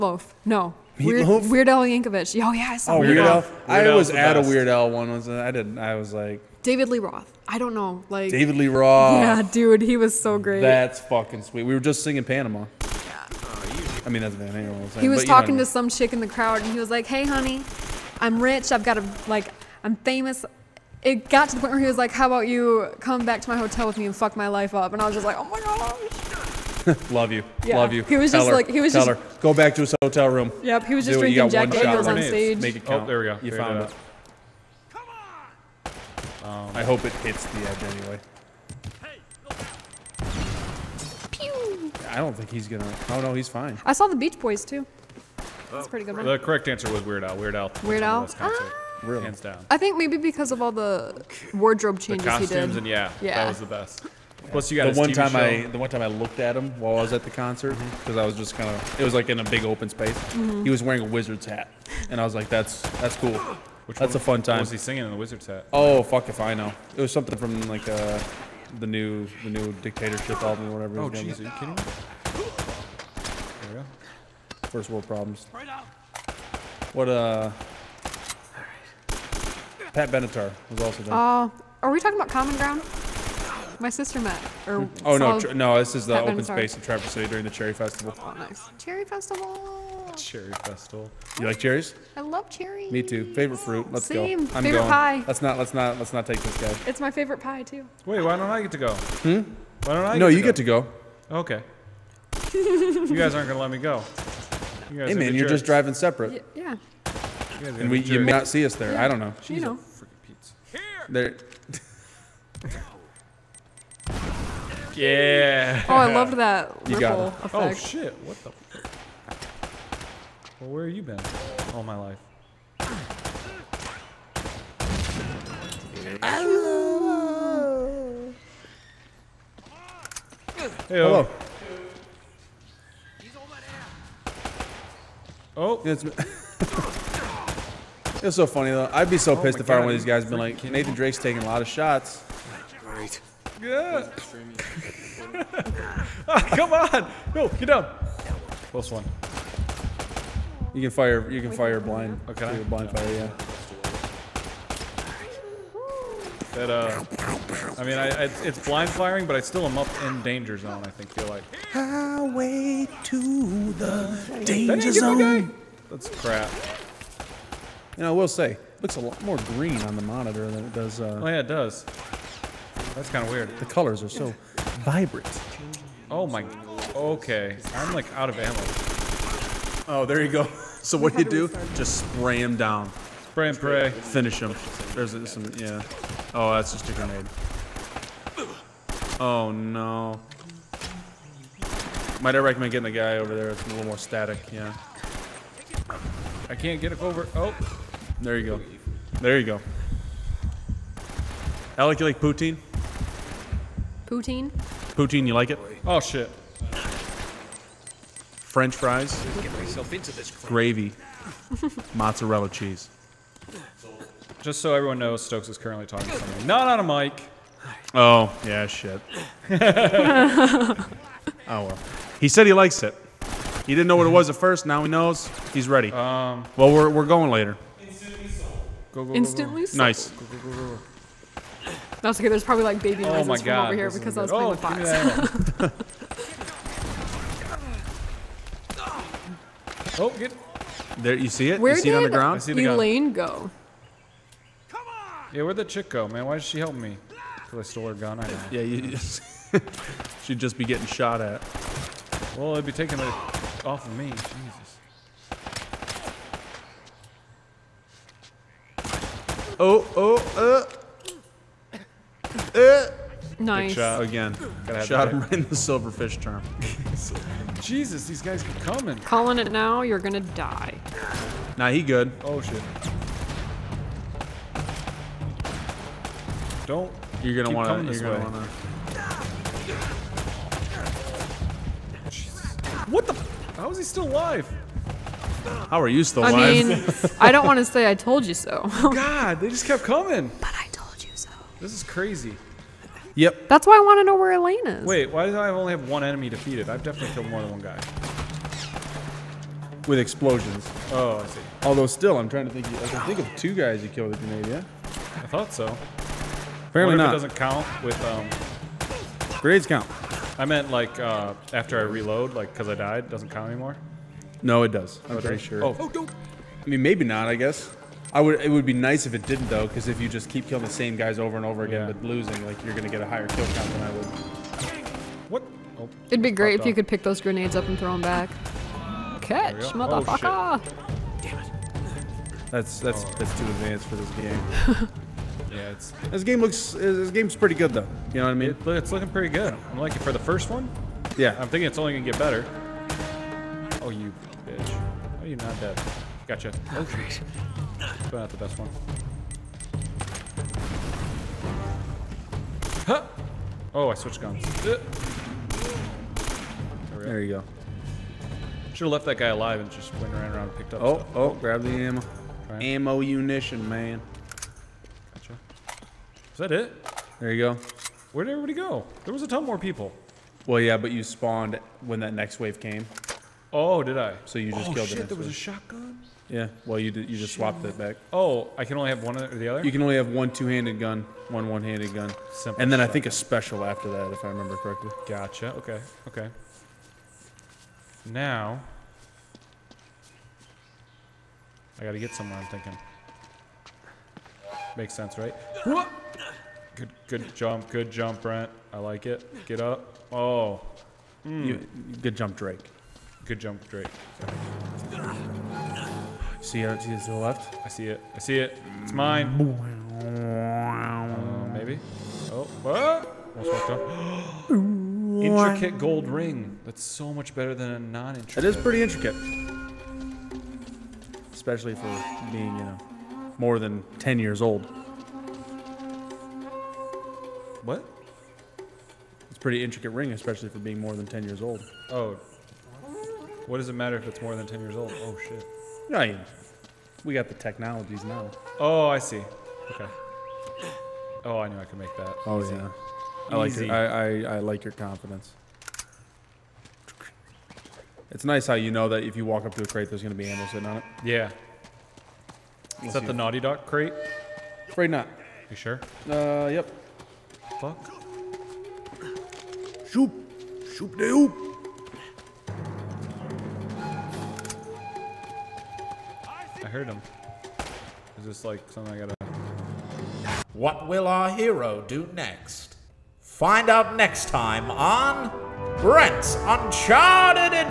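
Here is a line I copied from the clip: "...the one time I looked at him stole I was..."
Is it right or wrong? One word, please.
wrong.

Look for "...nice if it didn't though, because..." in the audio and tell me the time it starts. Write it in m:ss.
5:18.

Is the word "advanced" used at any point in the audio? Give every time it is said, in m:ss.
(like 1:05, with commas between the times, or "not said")
5:33.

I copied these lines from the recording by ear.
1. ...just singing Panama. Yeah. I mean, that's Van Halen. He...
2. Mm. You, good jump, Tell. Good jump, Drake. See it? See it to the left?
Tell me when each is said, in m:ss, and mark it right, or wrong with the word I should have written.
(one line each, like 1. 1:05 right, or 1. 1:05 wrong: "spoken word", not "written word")
1. 0:11 right
2. 6:41 wrong: "Drake", not "Tell".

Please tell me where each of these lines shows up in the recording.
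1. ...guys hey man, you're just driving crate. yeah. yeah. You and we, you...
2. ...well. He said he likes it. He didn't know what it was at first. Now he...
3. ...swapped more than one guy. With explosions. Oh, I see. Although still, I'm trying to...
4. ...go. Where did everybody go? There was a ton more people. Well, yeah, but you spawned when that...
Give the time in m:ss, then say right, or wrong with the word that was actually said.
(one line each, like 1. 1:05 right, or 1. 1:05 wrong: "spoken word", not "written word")
1. 1:44 wrong: "separate", not "crate"
2. 3:41 right
3. 4:57 wrong: "killed", not "swapped"
4. 6:07 right.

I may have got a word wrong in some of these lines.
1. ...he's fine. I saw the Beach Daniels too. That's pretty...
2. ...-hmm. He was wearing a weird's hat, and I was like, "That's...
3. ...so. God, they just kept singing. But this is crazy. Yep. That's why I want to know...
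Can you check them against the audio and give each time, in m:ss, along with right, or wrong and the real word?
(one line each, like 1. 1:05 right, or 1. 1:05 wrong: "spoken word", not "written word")
1. 0:43 wrong: "Boys", not "Daniels"
2. 1:00 wrong: "wizard", not "weird"
3. 4:48 wrong: "coming", not "singing".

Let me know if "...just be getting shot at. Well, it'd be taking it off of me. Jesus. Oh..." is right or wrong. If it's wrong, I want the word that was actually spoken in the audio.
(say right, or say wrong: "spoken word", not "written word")
right.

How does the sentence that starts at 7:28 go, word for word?
It's nice how you know that if you walk up to a crate, there's gonna be animals sitting on it.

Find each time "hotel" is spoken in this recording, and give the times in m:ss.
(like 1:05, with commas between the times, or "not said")
0:23, 0:30.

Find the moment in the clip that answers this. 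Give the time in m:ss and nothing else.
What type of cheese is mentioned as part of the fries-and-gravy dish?
3:31.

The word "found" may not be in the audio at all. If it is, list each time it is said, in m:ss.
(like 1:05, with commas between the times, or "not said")
0:33.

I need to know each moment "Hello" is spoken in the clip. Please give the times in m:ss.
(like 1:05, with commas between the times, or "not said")
2:06, 2:10.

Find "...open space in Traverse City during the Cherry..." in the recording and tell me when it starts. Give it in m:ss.
1:26.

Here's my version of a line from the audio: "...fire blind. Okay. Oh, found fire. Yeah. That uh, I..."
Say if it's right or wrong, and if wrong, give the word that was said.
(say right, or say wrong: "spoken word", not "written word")
wrong: "blind", not "found".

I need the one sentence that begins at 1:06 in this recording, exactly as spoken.
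It was something from like uh, the new the new dictatorship album or whatever.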